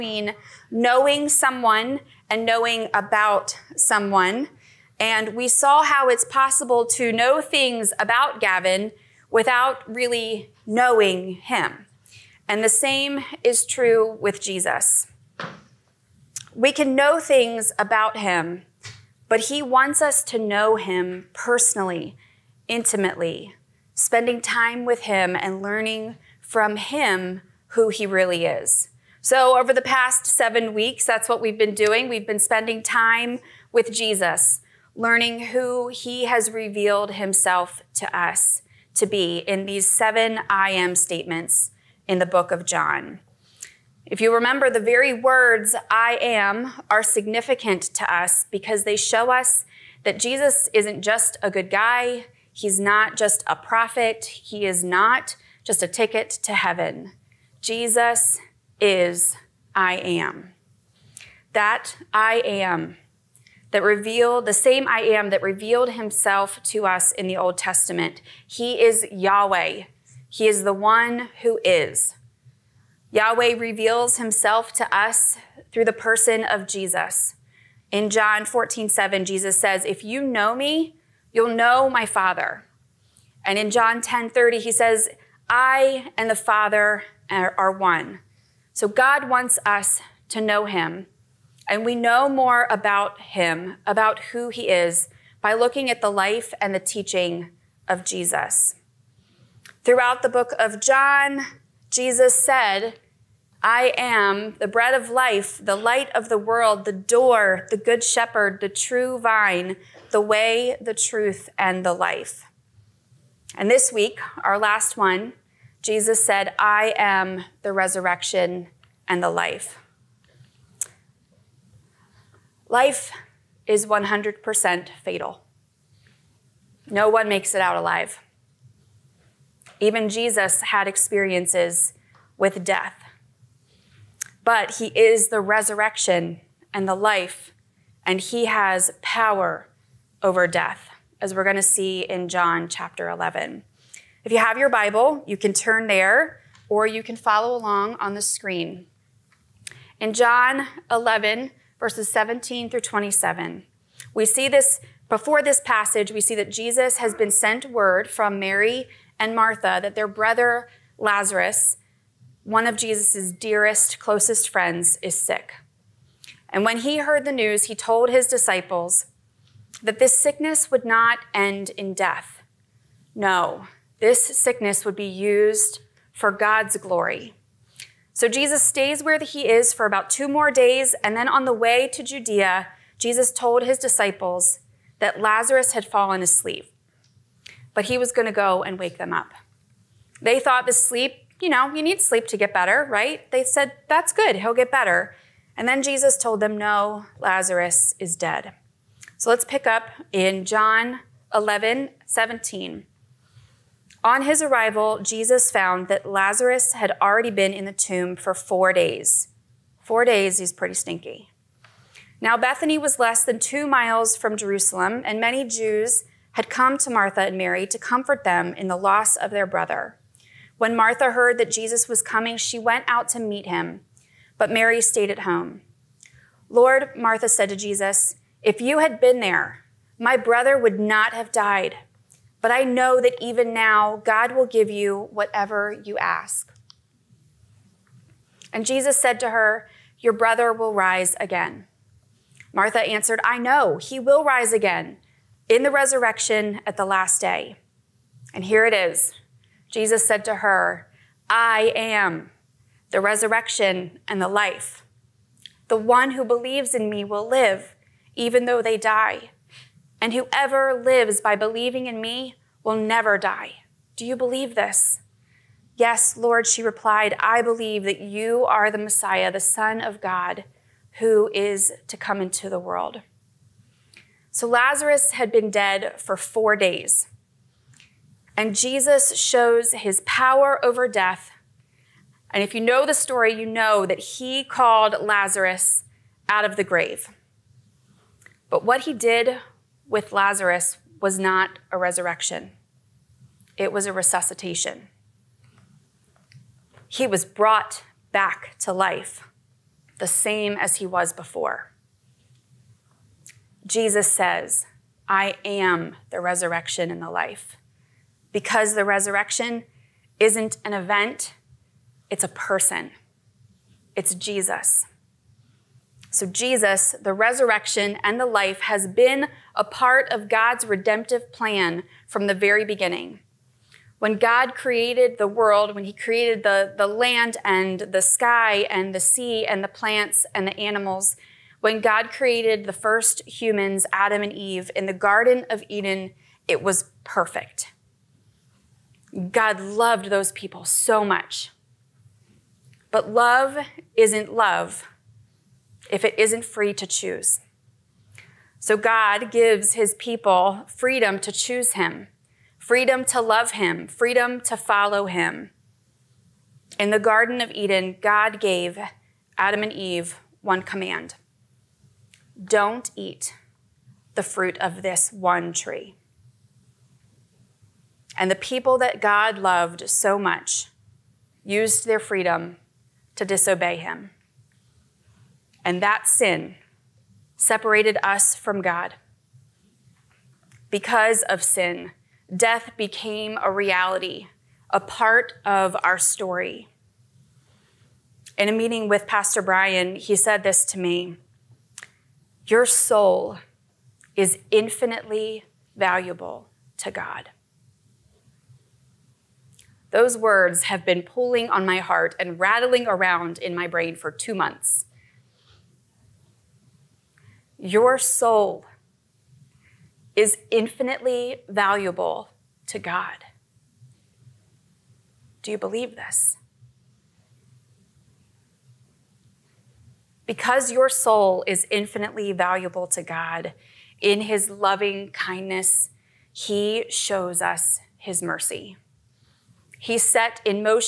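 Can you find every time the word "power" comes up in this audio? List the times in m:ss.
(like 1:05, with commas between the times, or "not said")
2:19, 4:40.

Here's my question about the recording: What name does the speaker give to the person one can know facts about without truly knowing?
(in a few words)
Gavin.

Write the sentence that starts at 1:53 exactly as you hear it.
And this week, our last one, Jesus said, I am the resurrection and the life.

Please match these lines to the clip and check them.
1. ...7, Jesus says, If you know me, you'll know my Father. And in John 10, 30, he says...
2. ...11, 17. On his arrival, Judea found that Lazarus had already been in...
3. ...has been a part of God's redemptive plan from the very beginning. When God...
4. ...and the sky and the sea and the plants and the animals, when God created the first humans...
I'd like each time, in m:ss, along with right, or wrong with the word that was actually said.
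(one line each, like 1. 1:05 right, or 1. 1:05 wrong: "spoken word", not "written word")
1. 1:18 right
2. 3:21 wrong: "Jesus", not "Judea"
3. 5:18 right
4. 5:27 right.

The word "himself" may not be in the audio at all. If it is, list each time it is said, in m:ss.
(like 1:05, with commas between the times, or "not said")
0:37, 1:05, 1:14.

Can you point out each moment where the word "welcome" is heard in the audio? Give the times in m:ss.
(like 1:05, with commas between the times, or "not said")
not said.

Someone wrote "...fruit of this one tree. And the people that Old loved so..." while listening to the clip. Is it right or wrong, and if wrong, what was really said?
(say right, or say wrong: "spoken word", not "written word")
wrong: "God", not "Old".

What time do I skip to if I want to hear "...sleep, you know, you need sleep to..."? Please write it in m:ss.
3:10.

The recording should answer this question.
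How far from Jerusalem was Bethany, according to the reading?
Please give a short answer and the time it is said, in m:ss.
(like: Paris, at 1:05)
Less than 2 miles, at 3:33.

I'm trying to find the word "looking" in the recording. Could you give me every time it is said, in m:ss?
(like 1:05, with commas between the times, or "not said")
1:35.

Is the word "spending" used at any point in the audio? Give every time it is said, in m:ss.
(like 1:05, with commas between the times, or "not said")
0:23, 0:32.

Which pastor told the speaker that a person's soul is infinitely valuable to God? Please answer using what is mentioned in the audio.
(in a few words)
Pastor Brian.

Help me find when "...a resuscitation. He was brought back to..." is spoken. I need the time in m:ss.
4:53.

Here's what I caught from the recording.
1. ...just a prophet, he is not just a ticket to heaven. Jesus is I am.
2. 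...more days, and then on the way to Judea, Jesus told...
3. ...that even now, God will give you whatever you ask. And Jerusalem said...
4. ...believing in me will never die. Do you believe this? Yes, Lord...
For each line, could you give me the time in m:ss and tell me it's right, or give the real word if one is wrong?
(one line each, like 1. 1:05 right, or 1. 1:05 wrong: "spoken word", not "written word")
1. 0:53 right
2. 3:00 right
3. 3:53 wrong: "Jesus", not "Jerusalem"
4. 4:21 right.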